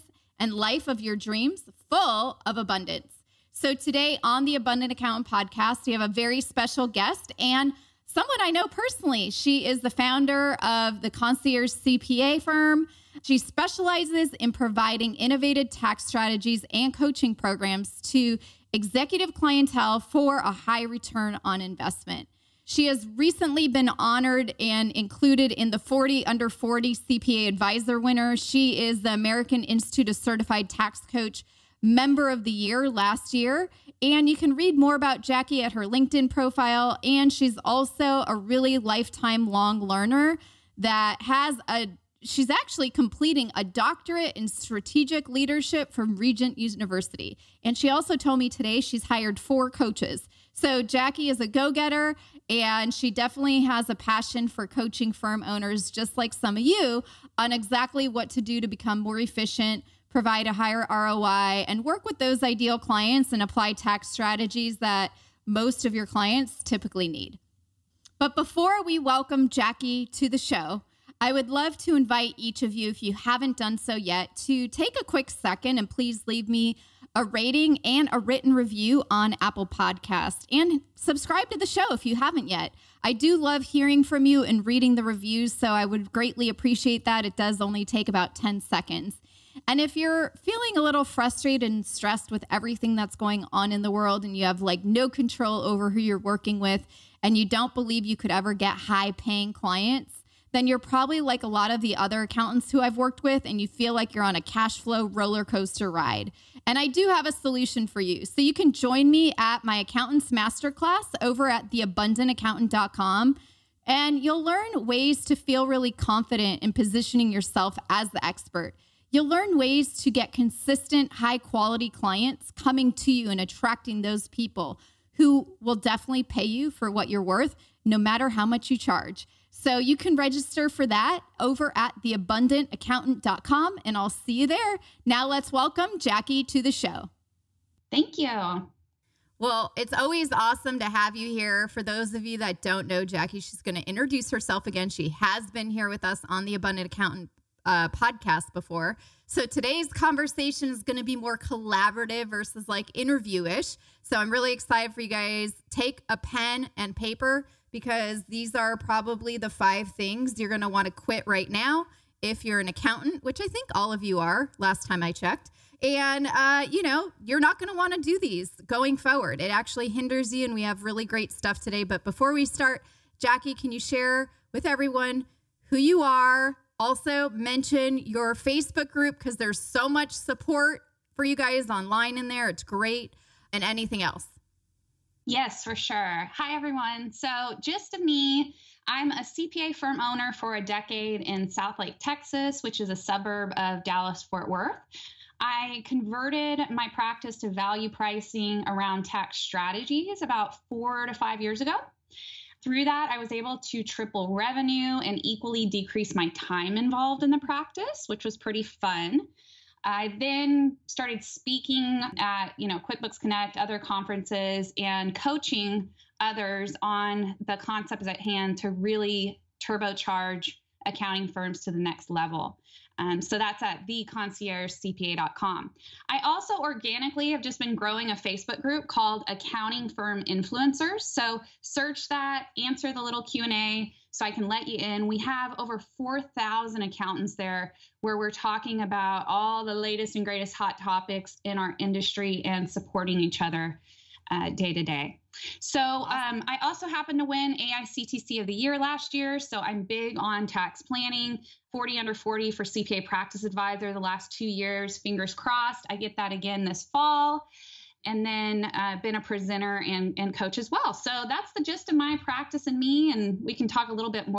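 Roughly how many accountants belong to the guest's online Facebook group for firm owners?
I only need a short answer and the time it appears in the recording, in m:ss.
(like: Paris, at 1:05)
over 4,000, at 3:55.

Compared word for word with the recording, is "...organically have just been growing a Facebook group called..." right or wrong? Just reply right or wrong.
right.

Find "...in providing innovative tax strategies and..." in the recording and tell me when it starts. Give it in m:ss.
0:14.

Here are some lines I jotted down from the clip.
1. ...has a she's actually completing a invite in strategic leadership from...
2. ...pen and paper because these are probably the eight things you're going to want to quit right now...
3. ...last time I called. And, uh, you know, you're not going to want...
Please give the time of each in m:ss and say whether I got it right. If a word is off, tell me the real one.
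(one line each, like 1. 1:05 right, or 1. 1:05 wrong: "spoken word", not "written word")
1. 0:41 wrong: "doctorate", not "invite"
2. 2:36 wrong: "five", not "eight"
3. 2:44 wrong: "checked", not "called".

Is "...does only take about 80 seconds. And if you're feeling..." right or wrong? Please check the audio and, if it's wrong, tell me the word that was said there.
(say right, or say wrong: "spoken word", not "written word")
wrong: "10", not "80".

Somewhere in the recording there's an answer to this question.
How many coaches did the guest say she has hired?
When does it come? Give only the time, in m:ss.
0:49.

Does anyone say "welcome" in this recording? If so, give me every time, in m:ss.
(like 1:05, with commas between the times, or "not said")
1:08, 2:15.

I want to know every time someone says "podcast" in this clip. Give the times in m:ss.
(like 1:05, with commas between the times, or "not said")
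0:05, 1:19, 2:27.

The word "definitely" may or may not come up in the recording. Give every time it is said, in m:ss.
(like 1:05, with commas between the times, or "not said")
0:53, 2:05.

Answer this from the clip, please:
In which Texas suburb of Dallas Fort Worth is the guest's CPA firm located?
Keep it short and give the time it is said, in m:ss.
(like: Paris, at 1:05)
Southlake, at 3:11.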